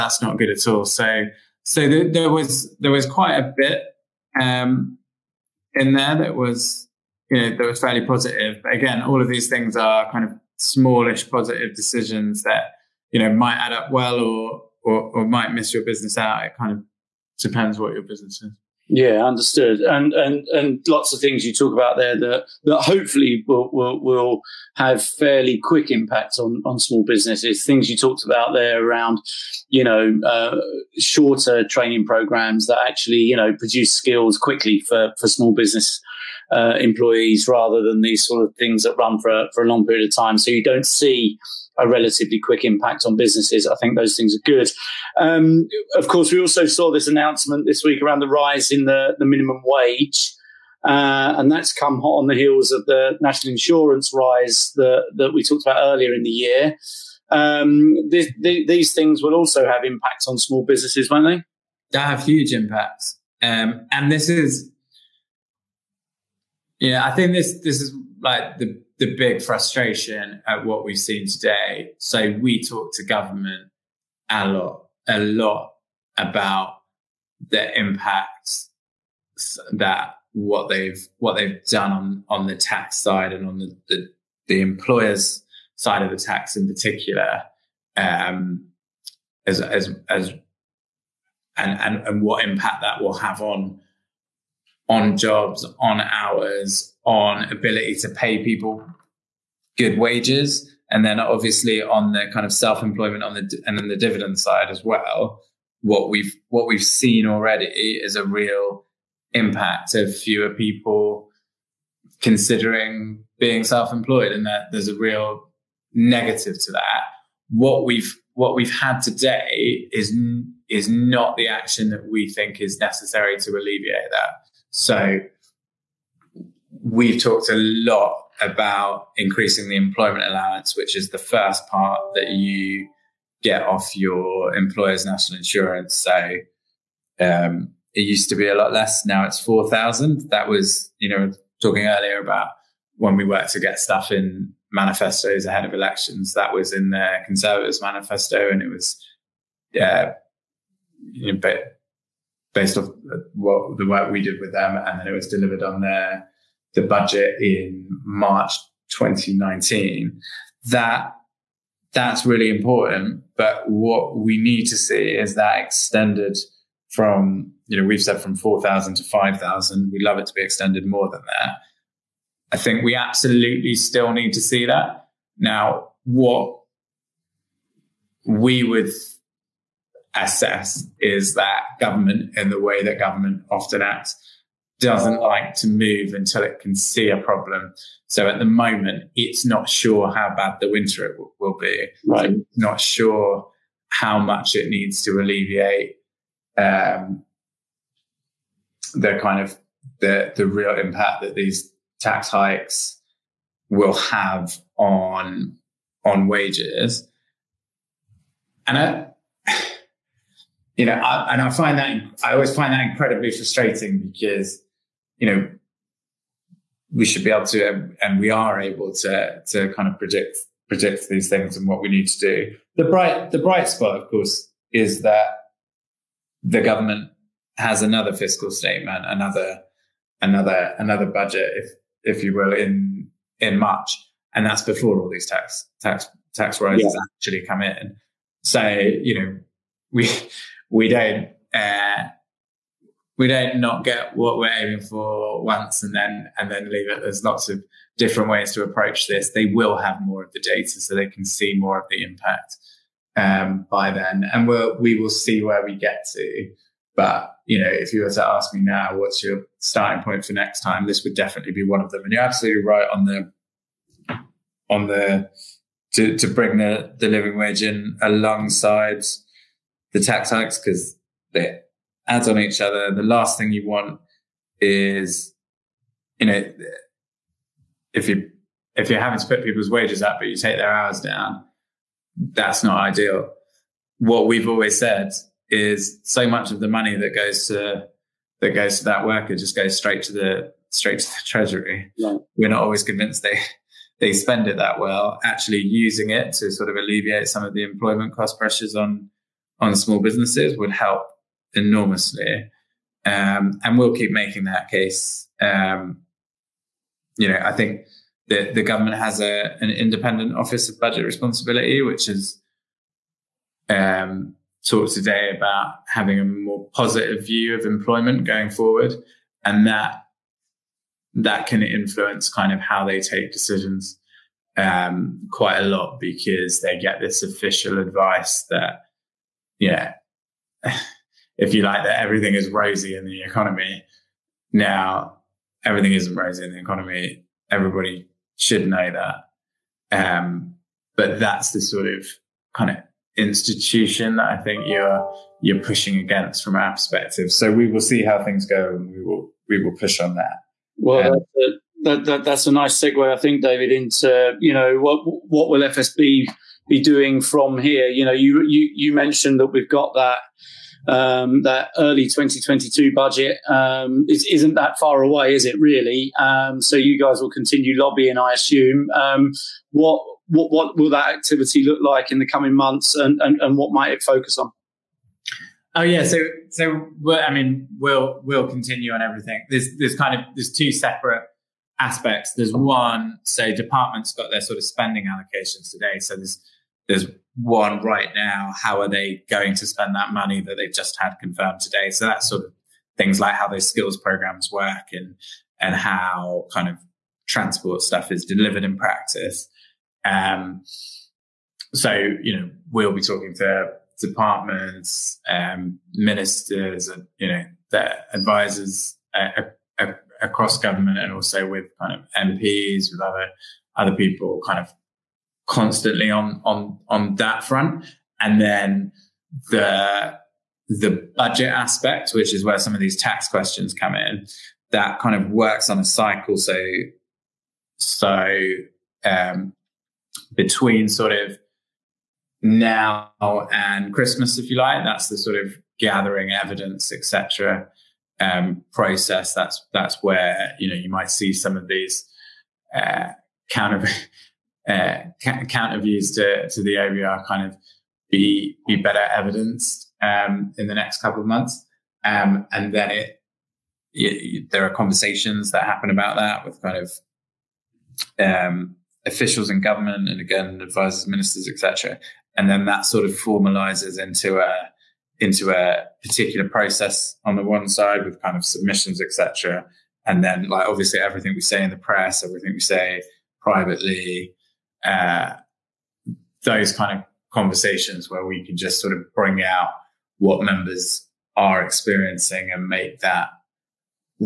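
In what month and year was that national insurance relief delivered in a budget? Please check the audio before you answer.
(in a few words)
March 2019.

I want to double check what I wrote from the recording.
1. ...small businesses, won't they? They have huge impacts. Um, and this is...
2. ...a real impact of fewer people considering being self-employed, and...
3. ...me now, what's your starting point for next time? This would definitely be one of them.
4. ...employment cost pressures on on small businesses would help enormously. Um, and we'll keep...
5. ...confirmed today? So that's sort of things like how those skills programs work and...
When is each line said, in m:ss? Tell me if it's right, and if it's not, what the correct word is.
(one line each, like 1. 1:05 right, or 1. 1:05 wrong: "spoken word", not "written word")
1. 1:00 right
2. 1:48 right
3. 4:18 right
4. 4:57 right
5. 6:31 right.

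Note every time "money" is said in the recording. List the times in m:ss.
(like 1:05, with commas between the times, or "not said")
4:46, 6:30.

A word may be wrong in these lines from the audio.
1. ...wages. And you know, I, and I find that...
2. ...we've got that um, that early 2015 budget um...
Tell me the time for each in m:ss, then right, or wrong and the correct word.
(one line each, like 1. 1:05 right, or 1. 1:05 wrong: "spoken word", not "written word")
1. 3:26 right
2. 5:59 wrong: "2022", not "2015".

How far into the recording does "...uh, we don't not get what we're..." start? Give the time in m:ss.
4:01.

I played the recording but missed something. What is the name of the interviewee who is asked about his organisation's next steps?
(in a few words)
David.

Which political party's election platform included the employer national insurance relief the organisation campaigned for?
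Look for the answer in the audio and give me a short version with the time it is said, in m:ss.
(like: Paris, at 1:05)
Conservatives, at 2:27.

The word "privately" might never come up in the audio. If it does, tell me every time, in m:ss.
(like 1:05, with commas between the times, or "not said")
7:53.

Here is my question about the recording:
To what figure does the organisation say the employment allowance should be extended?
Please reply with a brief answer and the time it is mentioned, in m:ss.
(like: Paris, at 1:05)
5,000, at 2:49.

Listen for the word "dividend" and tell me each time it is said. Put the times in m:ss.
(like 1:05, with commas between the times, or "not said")
1:43.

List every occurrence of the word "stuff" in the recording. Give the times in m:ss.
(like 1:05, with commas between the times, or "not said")
2:23, 6:37.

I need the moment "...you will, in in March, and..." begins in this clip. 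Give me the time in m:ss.
3:52.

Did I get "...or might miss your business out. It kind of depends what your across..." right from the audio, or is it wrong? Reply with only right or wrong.
wrong.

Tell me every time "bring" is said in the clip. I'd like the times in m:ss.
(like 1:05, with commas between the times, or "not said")
4:26, 7:59.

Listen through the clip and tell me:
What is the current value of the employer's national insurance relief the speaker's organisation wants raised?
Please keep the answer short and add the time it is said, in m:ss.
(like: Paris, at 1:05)
4,000, at 2:19.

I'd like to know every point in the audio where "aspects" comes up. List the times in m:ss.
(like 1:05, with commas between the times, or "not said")
6:21, 7:01.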